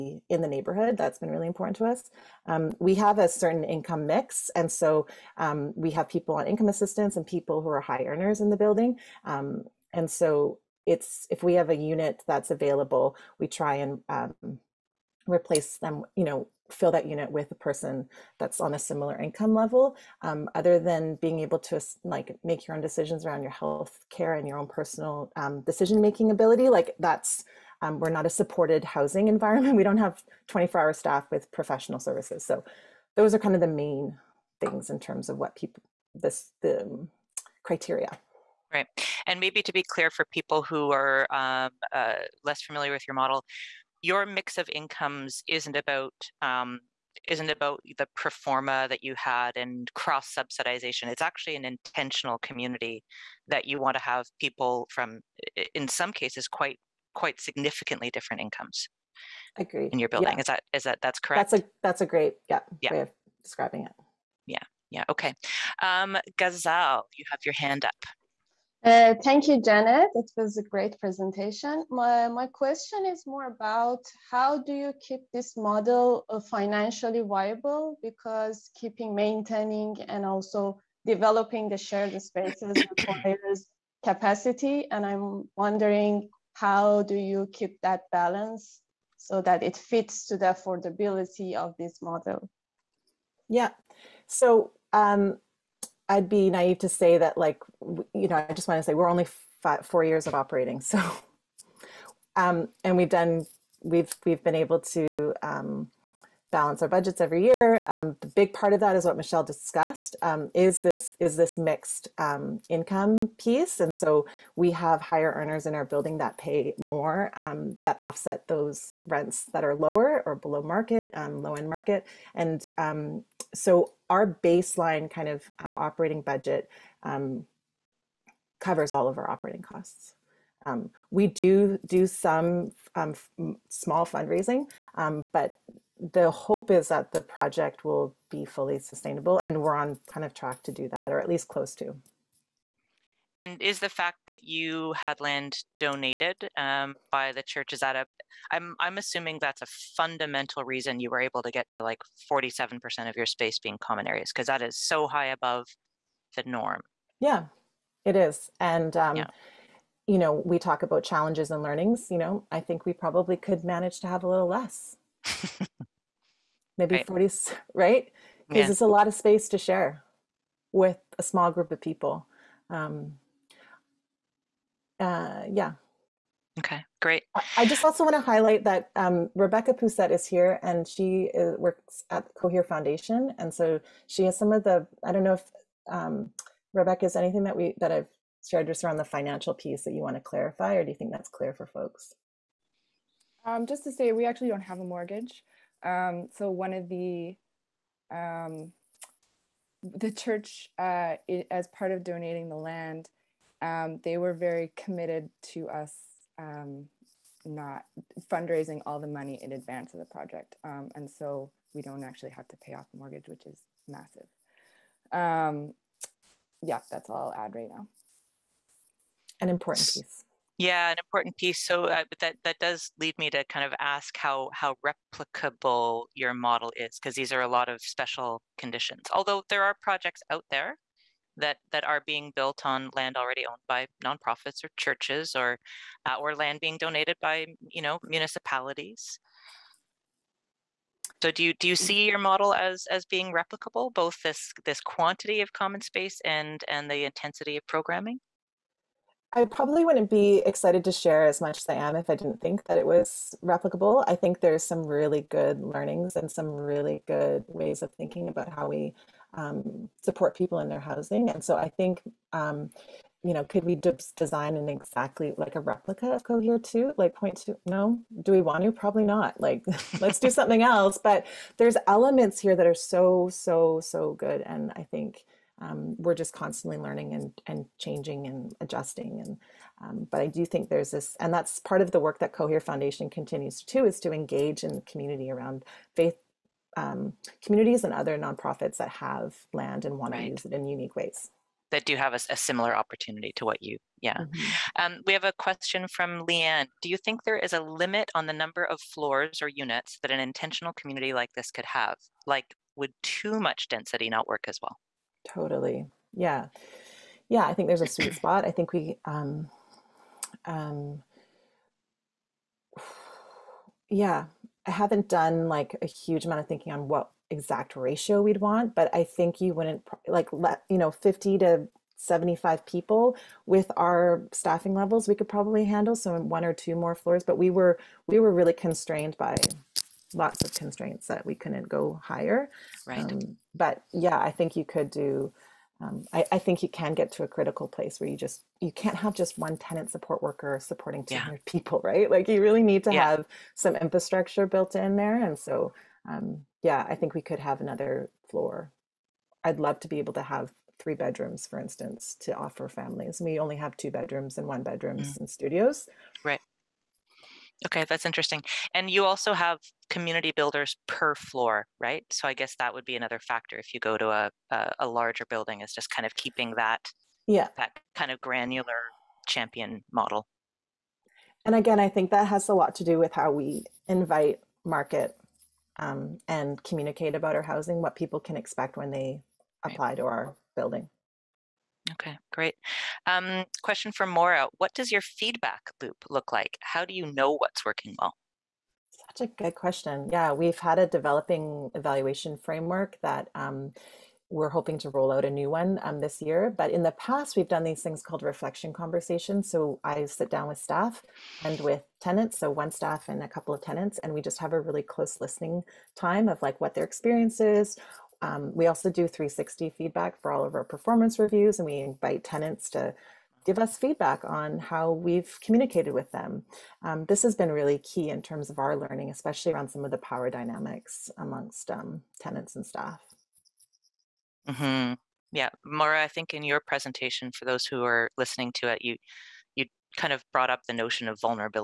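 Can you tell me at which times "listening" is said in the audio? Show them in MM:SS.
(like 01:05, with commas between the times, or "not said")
06:45, 07:08.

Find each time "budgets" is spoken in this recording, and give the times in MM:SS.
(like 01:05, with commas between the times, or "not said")
01:46, 02:06.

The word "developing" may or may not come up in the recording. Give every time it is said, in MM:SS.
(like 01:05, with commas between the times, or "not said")
01:21, 06:30.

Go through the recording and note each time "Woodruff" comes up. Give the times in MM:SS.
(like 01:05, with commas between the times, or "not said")
not said.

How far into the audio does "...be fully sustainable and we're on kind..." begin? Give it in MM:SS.
02:18.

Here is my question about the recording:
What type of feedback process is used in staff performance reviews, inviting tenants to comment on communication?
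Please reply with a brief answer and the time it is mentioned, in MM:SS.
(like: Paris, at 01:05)
360 feedback, at 06:49.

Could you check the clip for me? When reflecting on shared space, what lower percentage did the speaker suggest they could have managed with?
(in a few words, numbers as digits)
40.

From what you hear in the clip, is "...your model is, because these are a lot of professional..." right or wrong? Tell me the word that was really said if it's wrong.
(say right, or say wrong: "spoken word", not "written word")
wrong: "special", not "professional".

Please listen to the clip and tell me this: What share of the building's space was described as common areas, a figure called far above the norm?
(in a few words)
47%.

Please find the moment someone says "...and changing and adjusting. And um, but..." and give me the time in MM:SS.
04:37.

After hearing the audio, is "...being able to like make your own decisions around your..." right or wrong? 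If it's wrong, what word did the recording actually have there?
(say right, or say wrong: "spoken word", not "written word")
right.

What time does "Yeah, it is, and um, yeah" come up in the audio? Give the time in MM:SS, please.
02:37.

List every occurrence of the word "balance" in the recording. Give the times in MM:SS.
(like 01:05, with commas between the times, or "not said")
01:28, 01:46.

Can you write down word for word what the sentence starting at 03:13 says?
Um, just to say, we actually don't have a mortgage.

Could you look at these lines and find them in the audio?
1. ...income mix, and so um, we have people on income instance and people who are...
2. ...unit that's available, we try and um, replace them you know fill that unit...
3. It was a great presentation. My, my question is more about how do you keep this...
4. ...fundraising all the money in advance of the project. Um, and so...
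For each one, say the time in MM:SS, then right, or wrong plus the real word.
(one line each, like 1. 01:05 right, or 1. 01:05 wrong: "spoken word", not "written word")
1. 00:03 wrong: "assistance", not "instance"
2. 00:11 right
3. 01:10 right
4. 03:28 right.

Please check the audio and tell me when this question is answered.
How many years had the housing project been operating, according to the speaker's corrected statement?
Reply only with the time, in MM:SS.
01:39.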